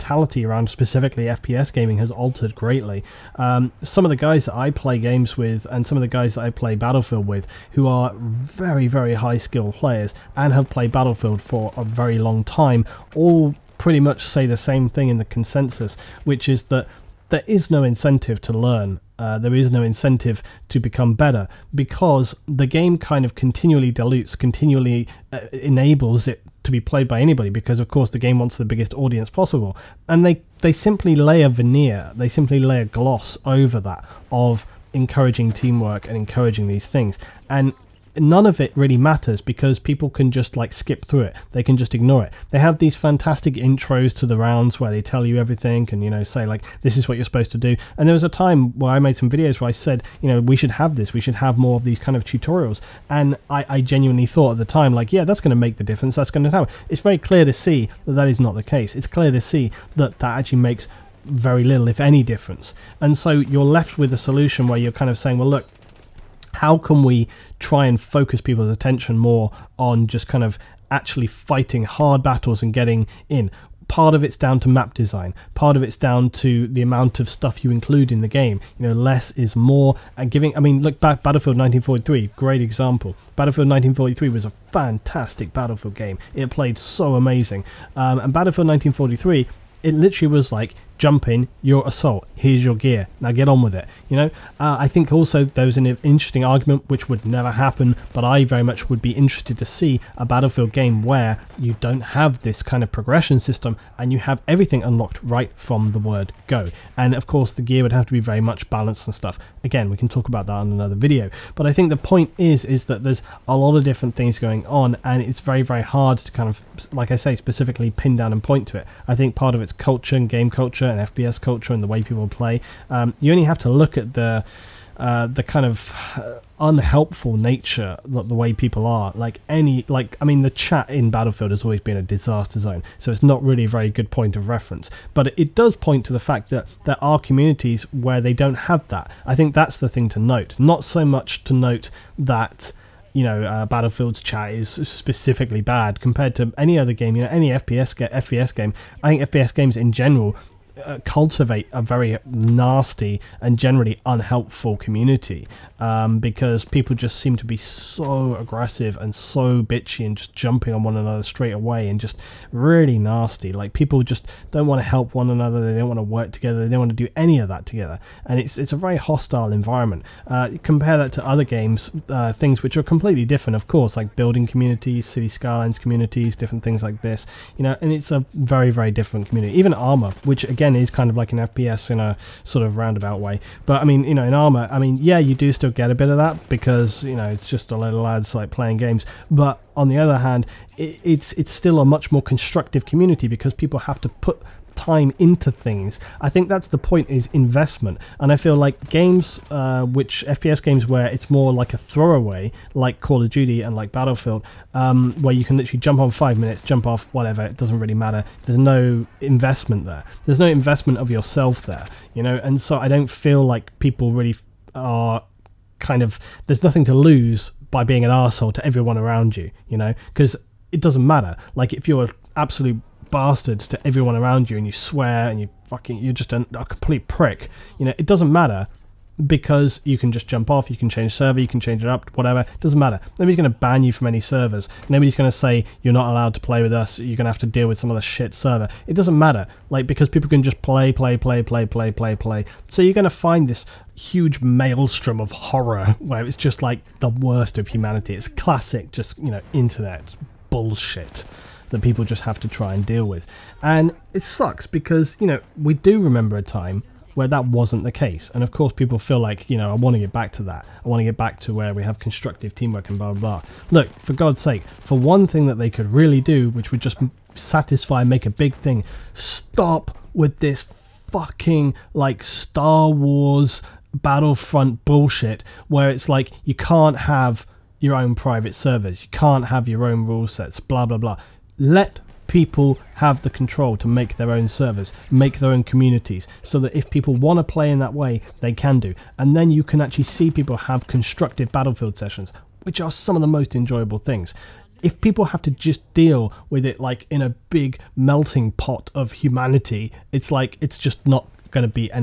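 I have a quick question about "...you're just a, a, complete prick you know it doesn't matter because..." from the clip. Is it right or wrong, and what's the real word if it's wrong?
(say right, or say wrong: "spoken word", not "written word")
right.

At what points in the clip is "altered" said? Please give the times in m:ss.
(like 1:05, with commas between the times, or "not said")
0:02.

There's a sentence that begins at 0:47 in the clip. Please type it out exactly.
And there was a time where I made some videos where I said you know we should have this.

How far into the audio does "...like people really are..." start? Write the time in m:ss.
3:33.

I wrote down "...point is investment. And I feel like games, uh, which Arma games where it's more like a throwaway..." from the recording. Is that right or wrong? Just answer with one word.
wrong.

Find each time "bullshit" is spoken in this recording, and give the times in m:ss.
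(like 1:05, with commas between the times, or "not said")
4:10, 4:34.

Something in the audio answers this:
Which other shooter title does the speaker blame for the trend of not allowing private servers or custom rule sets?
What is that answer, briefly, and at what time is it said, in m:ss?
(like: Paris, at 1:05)
Star Wars Battlefront, at 4:32.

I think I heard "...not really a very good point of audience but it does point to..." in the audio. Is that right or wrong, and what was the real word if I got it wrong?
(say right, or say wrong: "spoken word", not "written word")
wrong: "reference", not "audience".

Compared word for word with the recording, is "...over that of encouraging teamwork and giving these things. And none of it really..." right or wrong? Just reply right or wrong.
wrong.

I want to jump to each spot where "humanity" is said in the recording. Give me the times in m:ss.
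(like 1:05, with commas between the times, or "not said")
4:07, 4:59.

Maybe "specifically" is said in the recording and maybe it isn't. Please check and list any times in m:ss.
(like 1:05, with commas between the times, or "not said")
0:00, 1:57, 2:24.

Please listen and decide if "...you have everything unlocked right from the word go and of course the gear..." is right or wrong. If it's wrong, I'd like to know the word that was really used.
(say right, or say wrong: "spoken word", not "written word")
right.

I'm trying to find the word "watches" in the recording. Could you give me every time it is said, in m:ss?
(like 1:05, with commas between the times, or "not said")
not said.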